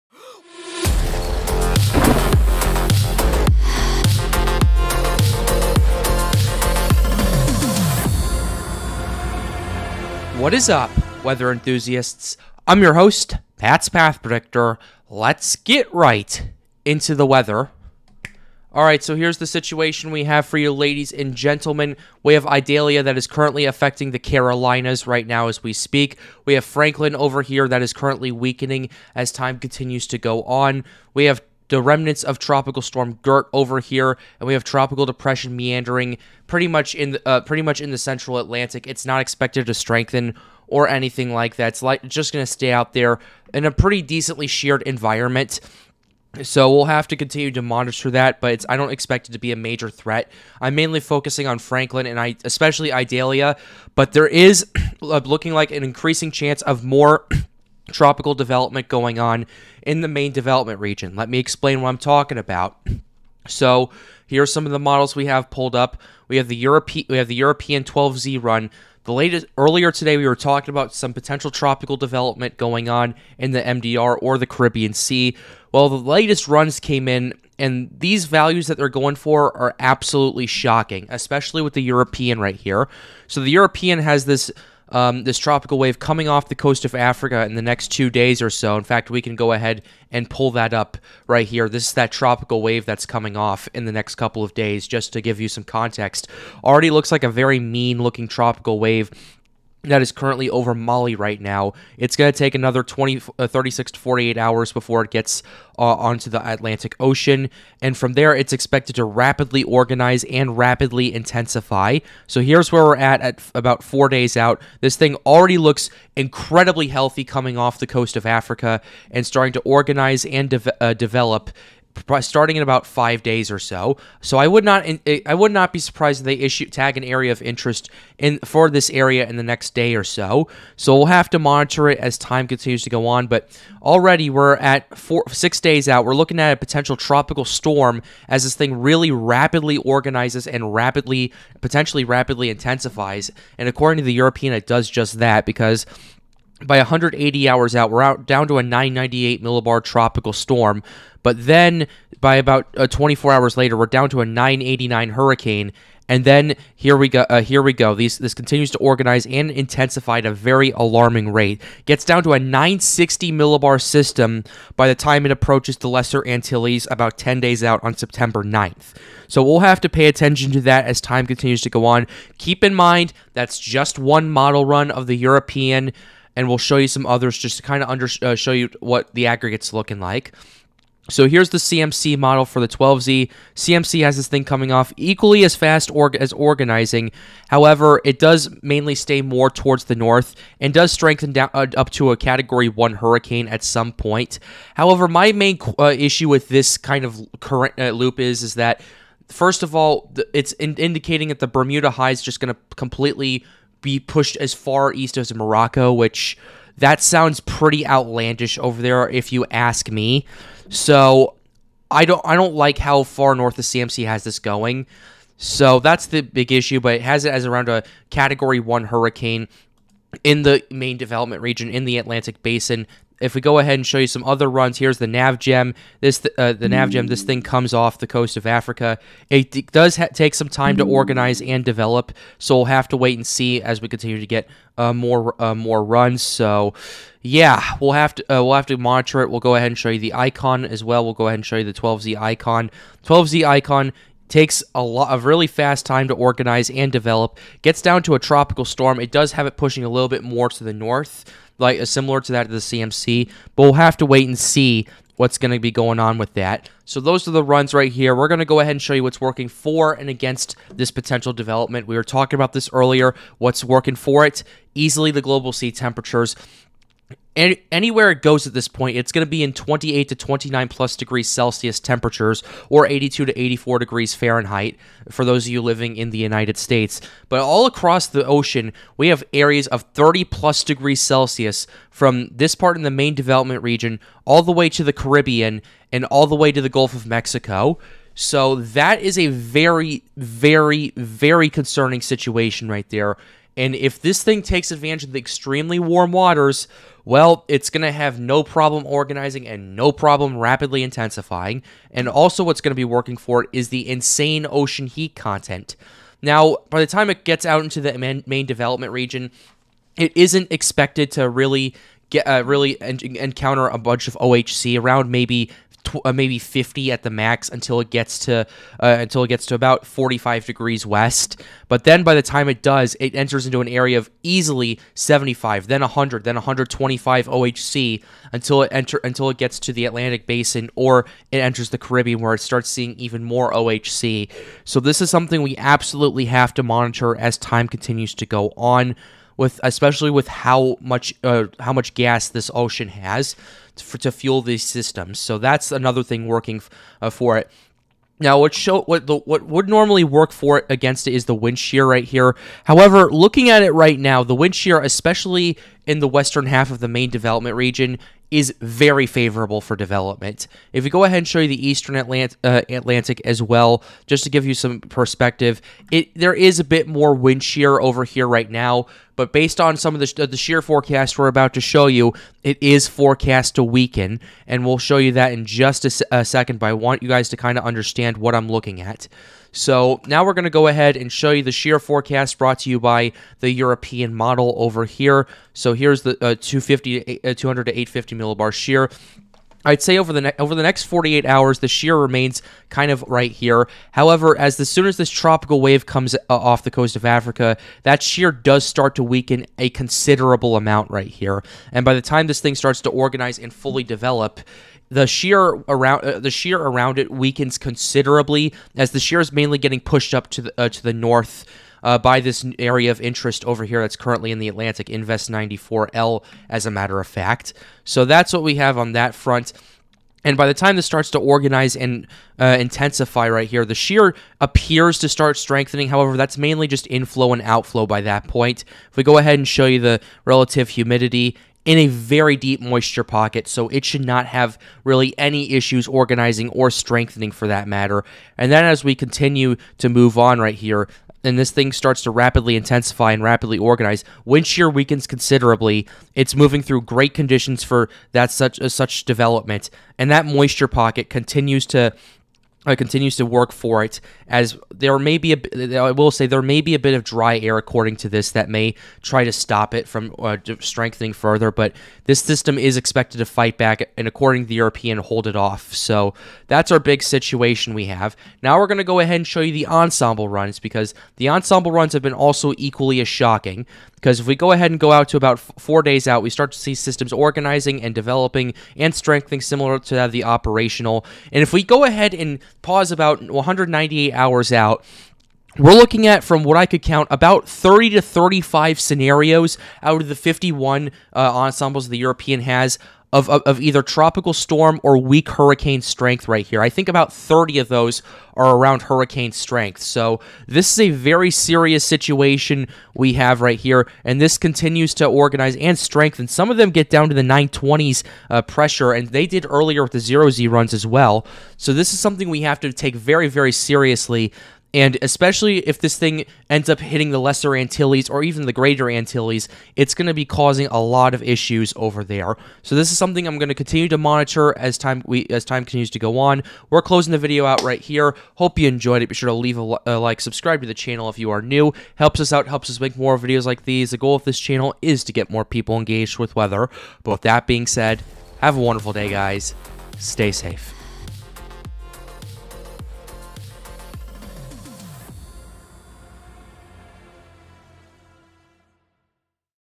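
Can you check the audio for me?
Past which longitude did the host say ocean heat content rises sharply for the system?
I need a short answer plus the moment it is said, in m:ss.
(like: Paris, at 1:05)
45 degrees west, at 5:19.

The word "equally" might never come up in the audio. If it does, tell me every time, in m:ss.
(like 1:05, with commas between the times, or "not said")
3:04, 7:52.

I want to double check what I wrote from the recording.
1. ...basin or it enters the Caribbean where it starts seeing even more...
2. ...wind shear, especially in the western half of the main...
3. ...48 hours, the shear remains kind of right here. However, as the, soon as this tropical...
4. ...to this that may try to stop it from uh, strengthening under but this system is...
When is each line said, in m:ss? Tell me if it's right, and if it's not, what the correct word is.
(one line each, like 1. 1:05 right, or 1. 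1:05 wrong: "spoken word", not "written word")
1. 5:30 right
2. 5:54 right
3. 6:30 right
4. 7:37 wrong: "further", not "under".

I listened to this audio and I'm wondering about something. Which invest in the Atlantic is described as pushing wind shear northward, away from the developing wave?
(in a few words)
Invest 94L.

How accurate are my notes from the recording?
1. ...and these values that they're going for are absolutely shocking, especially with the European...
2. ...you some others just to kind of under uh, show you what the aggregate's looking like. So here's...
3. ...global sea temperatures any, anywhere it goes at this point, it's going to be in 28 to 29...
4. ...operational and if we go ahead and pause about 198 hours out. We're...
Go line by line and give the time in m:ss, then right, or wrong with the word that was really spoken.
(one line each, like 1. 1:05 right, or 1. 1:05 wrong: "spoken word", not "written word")
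1. 1:17 right
2. 2:56 right
3. 4:25 right
4. 8:00 right.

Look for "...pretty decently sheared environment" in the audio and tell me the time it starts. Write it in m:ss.
0:43.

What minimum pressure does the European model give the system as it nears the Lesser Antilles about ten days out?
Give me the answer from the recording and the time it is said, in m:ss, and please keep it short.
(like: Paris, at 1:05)
960 millibars, at 2:42.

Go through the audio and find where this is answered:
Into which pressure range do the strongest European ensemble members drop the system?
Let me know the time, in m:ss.
8:27.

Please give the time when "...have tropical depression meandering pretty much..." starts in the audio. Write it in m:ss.
0:34.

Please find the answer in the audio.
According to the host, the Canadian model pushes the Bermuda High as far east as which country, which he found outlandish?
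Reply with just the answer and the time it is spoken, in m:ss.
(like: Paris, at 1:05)
Morocco, at 3:25.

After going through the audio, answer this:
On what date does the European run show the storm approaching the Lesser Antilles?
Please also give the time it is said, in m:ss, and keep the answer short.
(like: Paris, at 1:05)
September 9th, at 2:47.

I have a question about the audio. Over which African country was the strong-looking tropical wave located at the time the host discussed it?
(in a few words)
Mali.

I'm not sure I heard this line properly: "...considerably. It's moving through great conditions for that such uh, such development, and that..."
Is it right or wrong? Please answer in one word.
right.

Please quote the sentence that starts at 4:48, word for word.
So that is a very, very, very concerning situation right there.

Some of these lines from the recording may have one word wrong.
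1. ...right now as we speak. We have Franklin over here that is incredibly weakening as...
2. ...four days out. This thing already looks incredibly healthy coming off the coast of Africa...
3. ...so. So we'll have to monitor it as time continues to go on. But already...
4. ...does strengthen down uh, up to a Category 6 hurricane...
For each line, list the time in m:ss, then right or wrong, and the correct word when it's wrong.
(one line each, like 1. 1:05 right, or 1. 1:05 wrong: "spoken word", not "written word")
1. 0:25 wrong: "currently", not "incredibly"
2. 1:53 right
3. 2:10 right
4. 3:10 wrong: "1", not "6".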